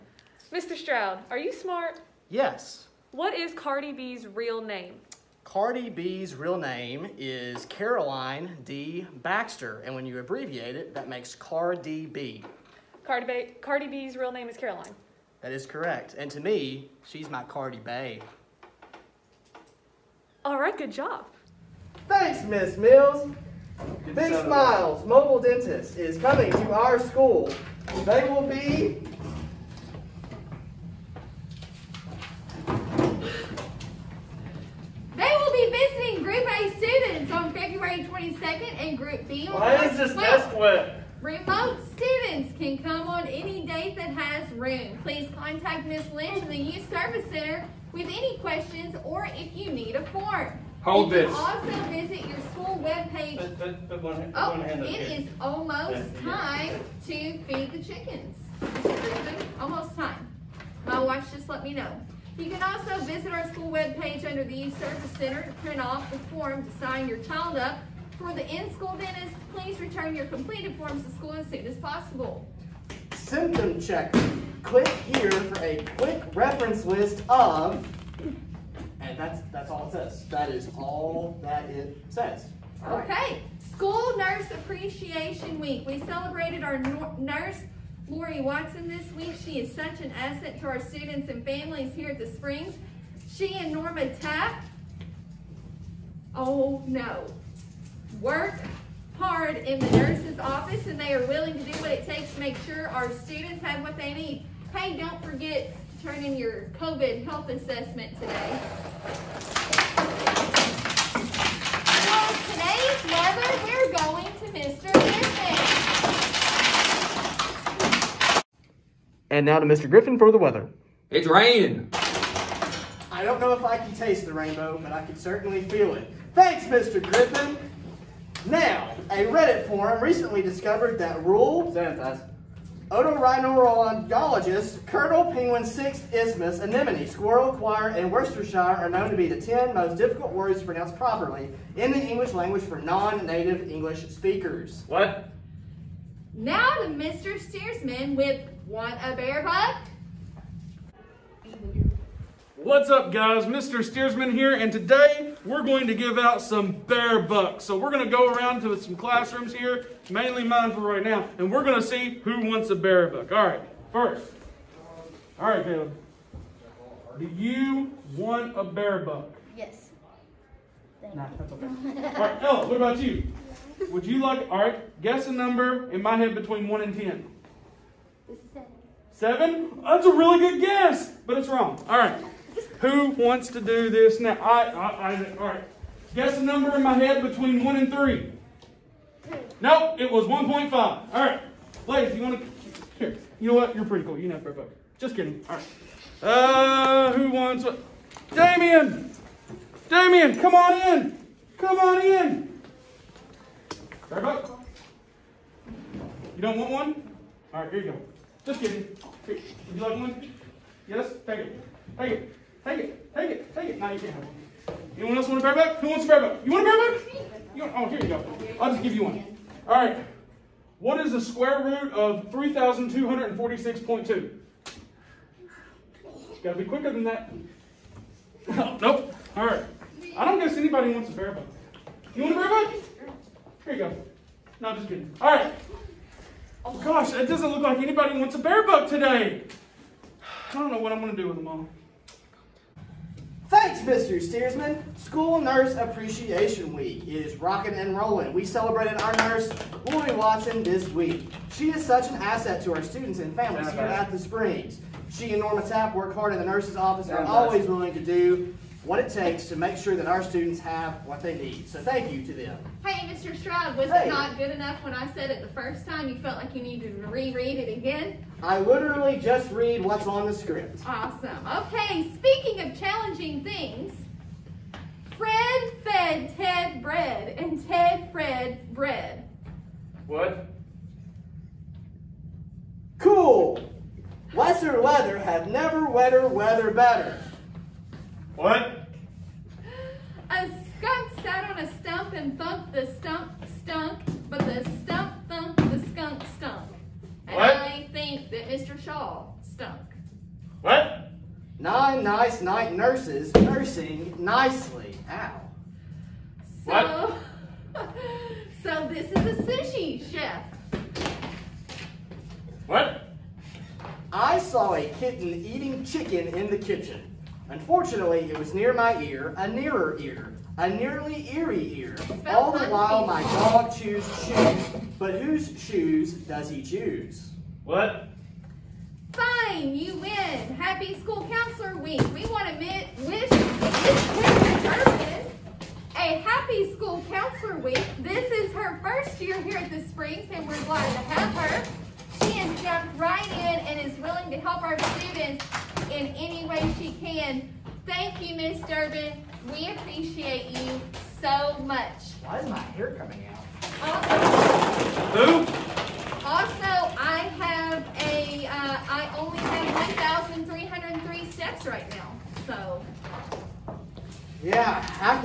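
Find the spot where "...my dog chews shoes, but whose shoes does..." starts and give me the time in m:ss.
5:23.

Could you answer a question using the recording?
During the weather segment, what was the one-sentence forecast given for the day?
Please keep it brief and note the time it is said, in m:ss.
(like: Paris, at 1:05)
It's raining, at 2:01.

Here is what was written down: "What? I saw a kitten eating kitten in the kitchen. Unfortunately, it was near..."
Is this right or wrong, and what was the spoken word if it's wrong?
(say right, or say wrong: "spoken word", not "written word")
wrong: "chicken", not "kitten".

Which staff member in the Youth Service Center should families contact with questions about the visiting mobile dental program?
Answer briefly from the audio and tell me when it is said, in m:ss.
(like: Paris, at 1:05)
Ms. Lynch, at 0:45.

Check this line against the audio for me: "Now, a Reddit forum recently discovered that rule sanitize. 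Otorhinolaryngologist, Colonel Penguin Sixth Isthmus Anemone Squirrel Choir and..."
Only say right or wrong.
right.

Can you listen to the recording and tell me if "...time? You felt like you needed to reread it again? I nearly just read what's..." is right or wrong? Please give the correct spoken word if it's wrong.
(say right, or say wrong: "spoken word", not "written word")
wrong: "literally", not "nearly".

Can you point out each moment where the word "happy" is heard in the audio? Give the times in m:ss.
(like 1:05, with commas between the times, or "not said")
5:30, 5:36.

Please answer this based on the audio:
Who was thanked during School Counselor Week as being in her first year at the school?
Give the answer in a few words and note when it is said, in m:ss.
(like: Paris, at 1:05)
Miss Durbin, at 5:48.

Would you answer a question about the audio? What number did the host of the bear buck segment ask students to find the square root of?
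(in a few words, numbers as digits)
3,246.2.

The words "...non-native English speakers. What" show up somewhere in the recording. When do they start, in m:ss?
2:22.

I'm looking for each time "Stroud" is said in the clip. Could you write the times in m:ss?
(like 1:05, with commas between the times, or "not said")
0:00, 4:23.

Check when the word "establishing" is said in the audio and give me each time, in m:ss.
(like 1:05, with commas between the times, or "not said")
not said.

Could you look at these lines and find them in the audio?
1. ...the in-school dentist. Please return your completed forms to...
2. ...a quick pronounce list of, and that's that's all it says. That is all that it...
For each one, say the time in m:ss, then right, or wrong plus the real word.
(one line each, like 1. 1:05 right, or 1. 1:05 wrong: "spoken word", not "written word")
1. 1:08 right
2. 1:15 wrong: "reference", not "pronounce".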